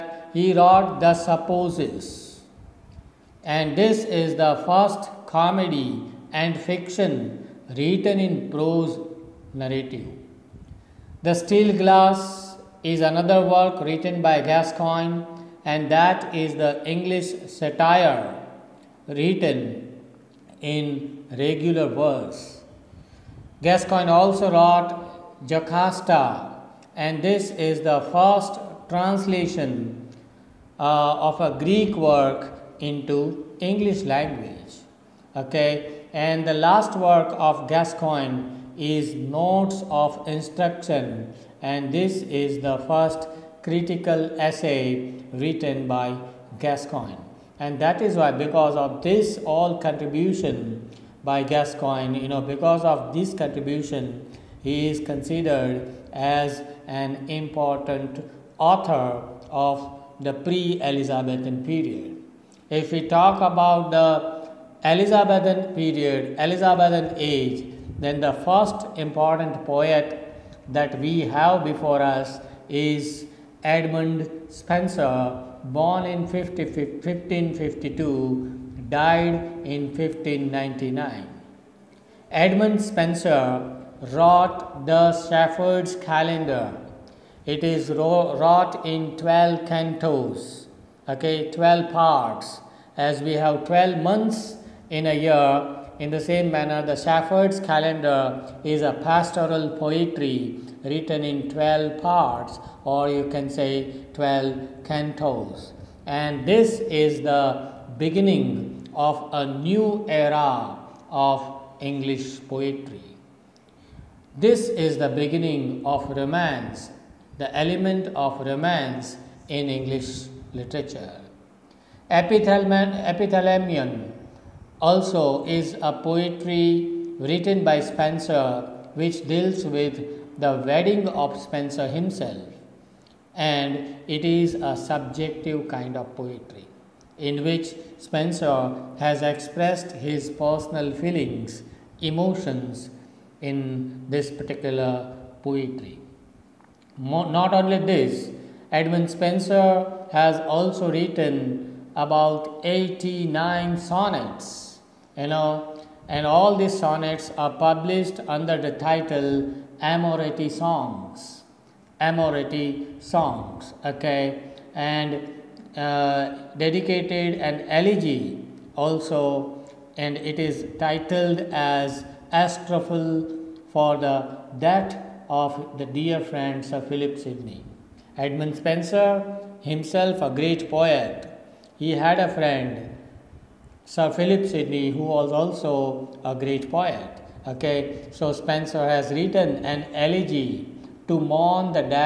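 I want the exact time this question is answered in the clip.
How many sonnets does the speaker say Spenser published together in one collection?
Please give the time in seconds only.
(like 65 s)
152 s.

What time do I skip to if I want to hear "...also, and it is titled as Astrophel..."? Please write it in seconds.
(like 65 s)
168 s.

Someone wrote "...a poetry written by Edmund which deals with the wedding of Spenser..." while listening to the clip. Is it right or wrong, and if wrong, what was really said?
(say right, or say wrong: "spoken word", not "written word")
wrong: "Spenser", not "Edmund".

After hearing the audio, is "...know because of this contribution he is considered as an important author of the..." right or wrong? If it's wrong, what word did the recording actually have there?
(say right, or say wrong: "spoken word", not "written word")
right.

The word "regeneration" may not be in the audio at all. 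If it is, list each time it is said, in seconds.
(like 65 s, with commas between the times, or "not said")
not said.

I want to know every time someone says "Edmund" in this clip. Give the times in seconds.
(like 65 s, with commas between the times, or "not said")
73 s, 82 s, 148 s, 178 s.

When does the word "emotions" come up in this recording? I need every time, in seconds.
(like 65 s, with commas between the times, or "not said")
141 s.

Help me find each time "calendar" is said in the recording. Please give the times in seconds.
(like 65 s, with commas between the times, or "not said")
85 s, 97 s.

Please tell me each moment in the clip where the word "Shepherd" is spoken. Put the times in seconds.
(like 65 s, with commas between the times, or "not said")
85 s, 96 s.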